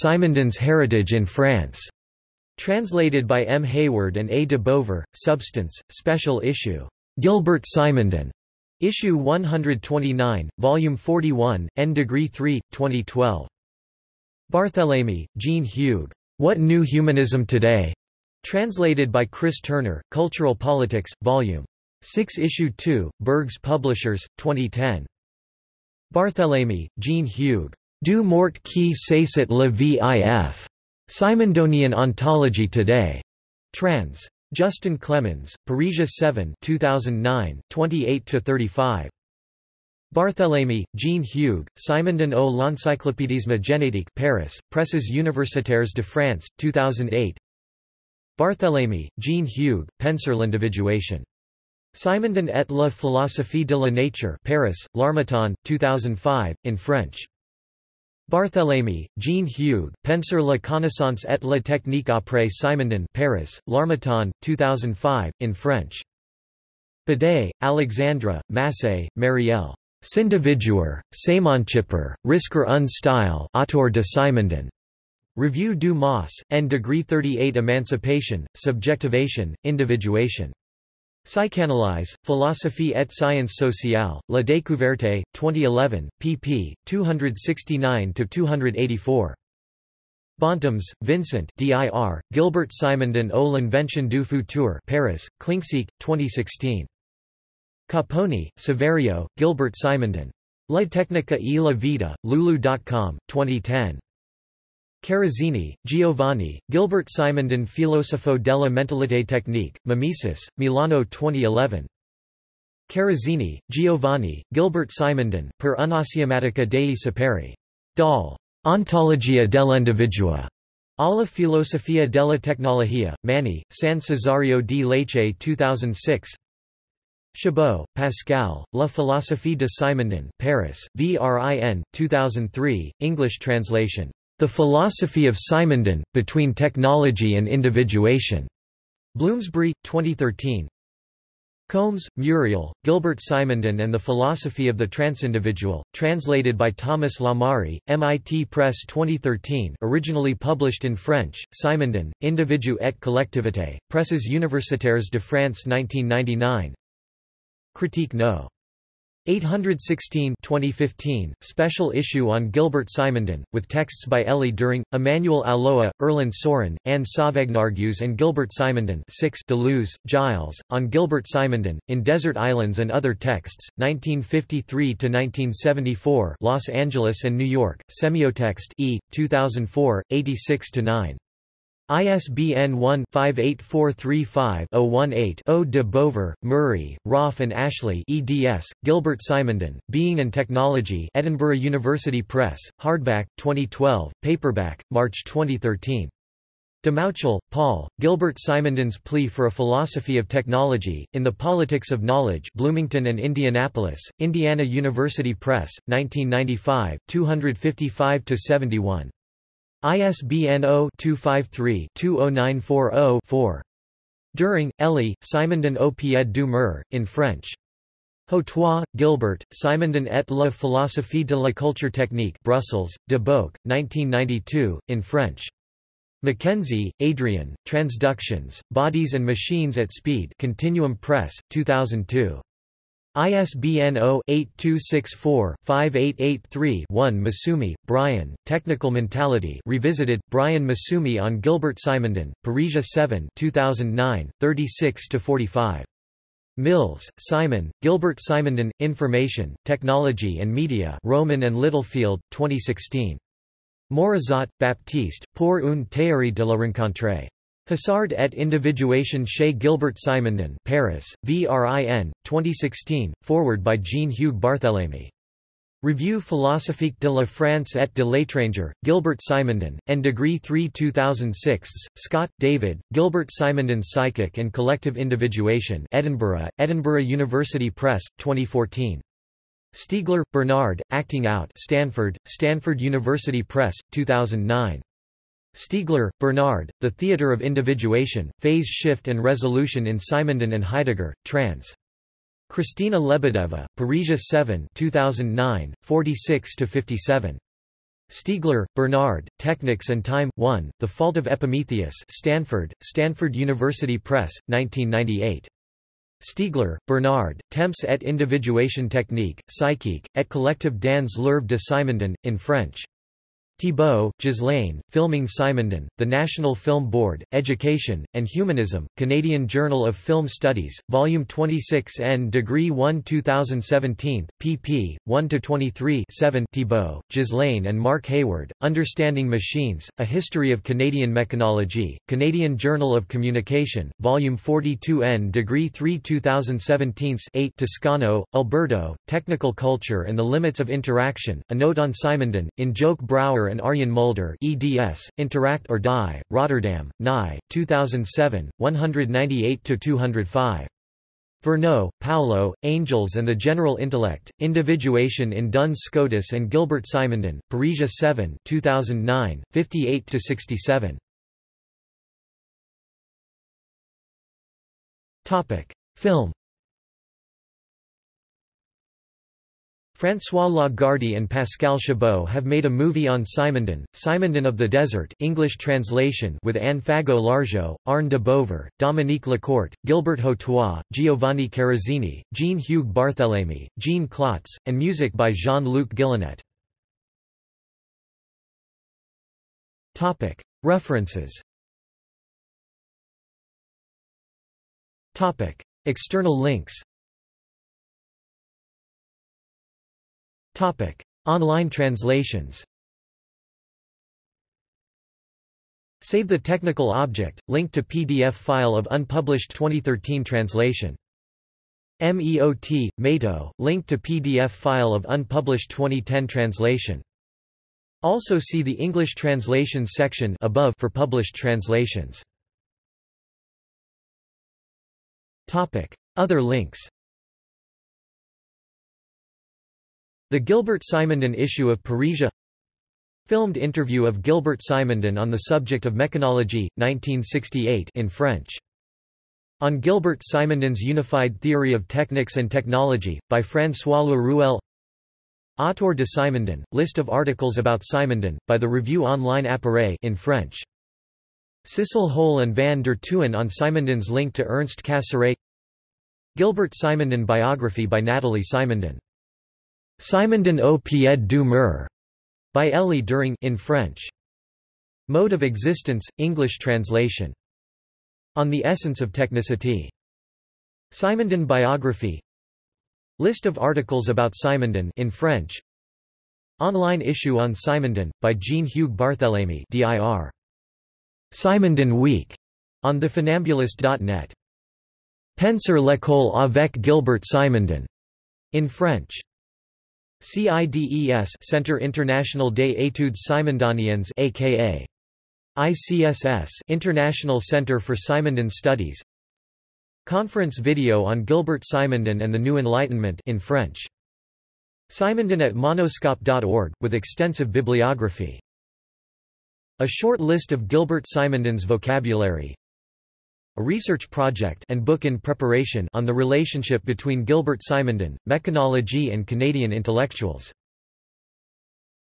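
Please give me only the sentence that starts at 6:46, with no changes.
Save the technical object, link to PDF file of unpublished 2013 translation.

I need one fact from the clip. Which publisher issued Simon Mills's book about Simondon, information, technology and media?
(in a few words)
Rowman and Littlefield.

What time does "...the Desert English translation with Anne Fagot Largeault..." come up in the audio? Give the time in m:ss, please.
6:14.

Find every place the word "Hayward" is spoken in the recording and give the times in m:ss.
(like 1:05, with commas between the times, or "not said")
0:03, 5:28.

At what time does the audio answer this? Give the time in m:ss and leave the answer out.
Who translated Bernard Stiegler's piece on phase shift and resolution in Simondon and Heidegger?
4:52.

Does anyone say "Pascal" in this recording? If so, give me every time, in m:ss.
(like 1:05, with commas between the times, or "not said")
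2:07, 6:11.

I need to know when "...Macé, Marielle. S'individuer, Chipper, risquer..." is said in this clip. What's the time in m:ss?
1:08.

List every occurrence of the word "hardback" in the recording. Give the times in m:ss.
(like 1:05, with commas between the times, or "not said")
3:12.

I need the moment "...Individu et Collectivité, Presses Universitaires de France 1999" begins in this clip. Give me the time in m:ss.
2:32.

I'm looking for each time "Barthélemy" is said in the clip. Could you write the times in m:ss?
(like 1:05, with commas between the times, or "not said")
0:14, 0:26, 0:40, 0:48, 0:58, 4:24, 6:22, 7:58.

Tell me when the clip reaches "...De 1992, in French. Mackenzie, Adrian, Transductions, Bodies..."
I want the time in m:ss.
3:43.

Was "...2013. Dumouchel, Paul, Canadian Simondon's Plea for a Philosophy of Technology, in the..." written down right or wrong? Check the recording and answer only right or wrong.
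wrong.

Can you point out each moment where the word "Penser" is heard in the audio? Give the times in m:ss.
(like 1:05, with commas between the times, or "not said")
0:49, 1:00, 8:05.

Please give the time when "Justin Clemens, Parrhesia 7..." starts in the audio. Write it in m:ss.
0:34.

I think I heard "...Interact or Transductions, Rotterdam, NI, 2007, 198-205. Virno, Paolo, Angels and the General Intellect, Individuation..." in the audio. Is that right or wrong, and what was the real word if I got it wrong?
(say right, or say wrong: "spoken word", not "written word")
wrong: "Die", not "Transductions".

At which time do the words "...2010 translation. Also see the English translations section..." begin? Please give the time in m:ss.
6:55.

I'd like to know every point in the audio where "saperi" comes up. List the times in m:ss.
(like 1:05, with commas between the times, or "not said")
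1:56.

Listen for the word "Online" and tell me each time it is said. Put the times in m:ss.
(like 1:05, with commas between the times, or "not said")
6:41, 7:29, 7:56.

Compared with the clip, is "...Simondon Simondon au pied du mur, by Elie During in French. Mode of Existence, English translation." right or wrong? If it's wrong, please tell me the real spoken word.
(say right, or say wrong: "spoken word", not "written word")
right.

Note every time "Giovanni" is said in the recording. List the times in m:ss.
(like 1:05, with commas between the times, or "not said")
1:45, 1:53, 6:20.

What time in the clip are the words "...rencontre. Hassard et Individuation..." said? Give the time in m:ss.
4:16.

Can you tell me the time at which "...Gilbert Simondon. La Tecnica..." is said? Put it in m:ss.
1:39.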